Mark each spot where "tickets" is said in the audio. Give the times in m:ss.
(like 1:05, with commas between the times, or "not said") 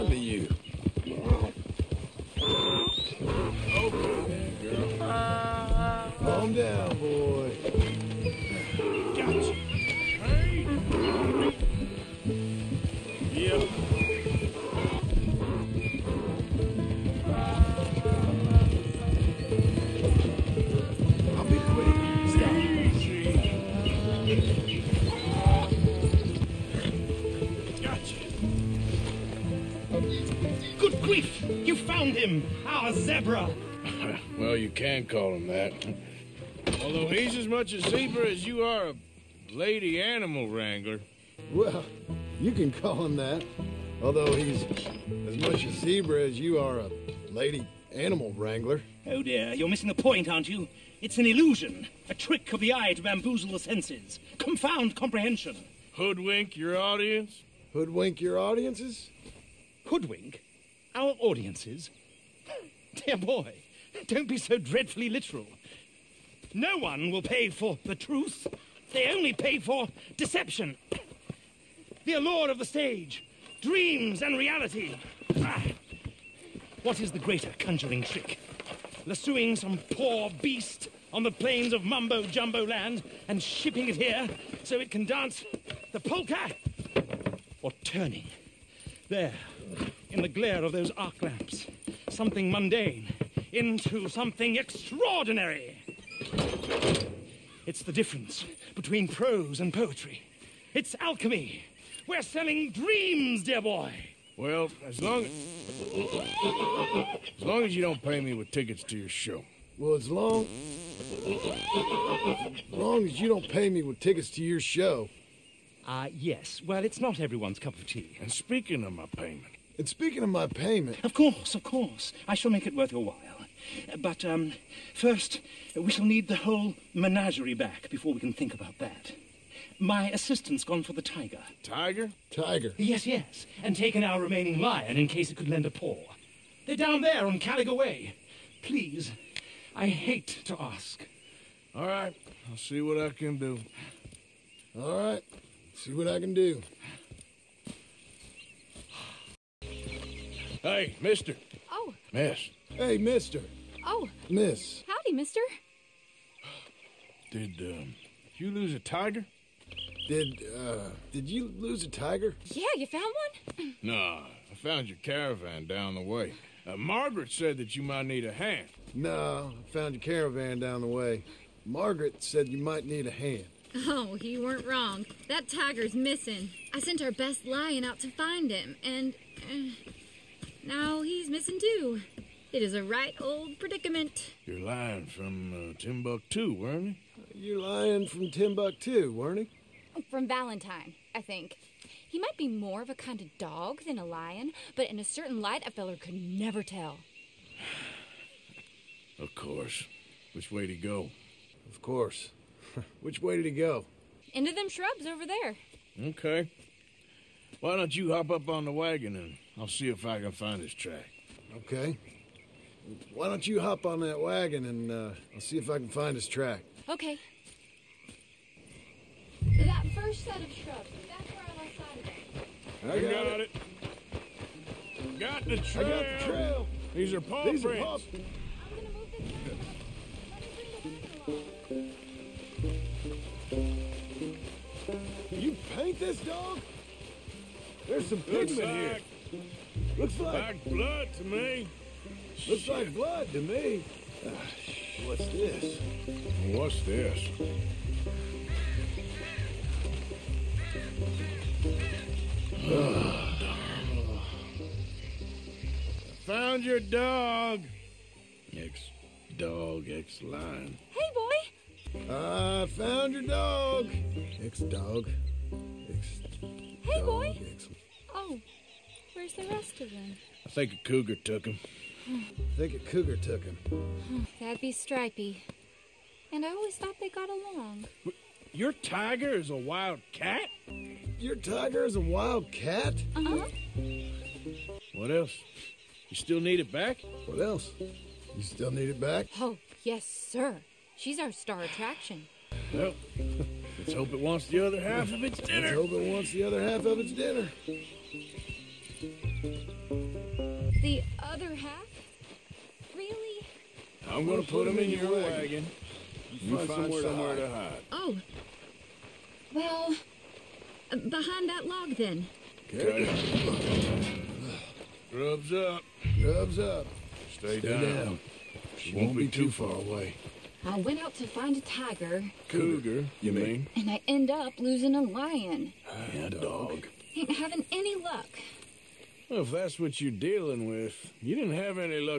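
1:48, 1:53.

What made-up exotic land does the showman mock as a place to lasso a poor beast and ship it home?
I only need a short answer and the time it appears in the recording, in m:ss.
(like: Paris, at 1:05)
Mumbo Jumbo land, at 1:21.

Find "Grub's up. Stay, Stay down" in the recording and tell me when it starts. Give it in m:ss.
5:16.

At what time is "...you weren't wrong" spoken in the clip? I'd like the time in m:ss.
2:54.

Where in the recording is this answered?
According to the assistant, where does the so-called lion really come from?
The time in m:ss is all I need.
3:10.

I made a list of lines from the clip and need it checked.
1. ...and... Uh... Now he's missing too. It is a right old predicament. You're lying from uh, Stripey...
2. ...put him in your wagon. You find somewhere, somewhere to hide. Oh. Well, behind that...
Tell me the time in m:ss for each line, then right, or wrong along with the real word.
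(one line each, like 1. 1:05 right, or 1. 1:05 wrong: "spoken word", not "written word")
1. 2:58 wrong: "Timbuktu", not "Stripey"
2. 5:04 right.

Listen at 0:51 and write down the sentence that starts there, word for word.
It's an illusion, a trick of the eye to bamboozle the senses, confound comprehension.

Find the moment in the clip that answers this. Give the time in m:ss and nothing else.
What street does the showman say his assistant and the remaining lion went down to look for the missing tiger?
2:17.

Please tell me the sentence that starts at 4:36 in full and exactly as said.
And I always thought they got along.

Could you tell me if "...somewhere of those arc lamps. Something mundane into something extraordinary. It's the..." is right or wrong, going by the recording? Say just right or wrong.
wrong.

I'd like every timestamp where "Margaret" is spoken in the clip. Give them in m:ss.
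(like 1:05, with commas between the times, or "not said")
2:46, 2:51.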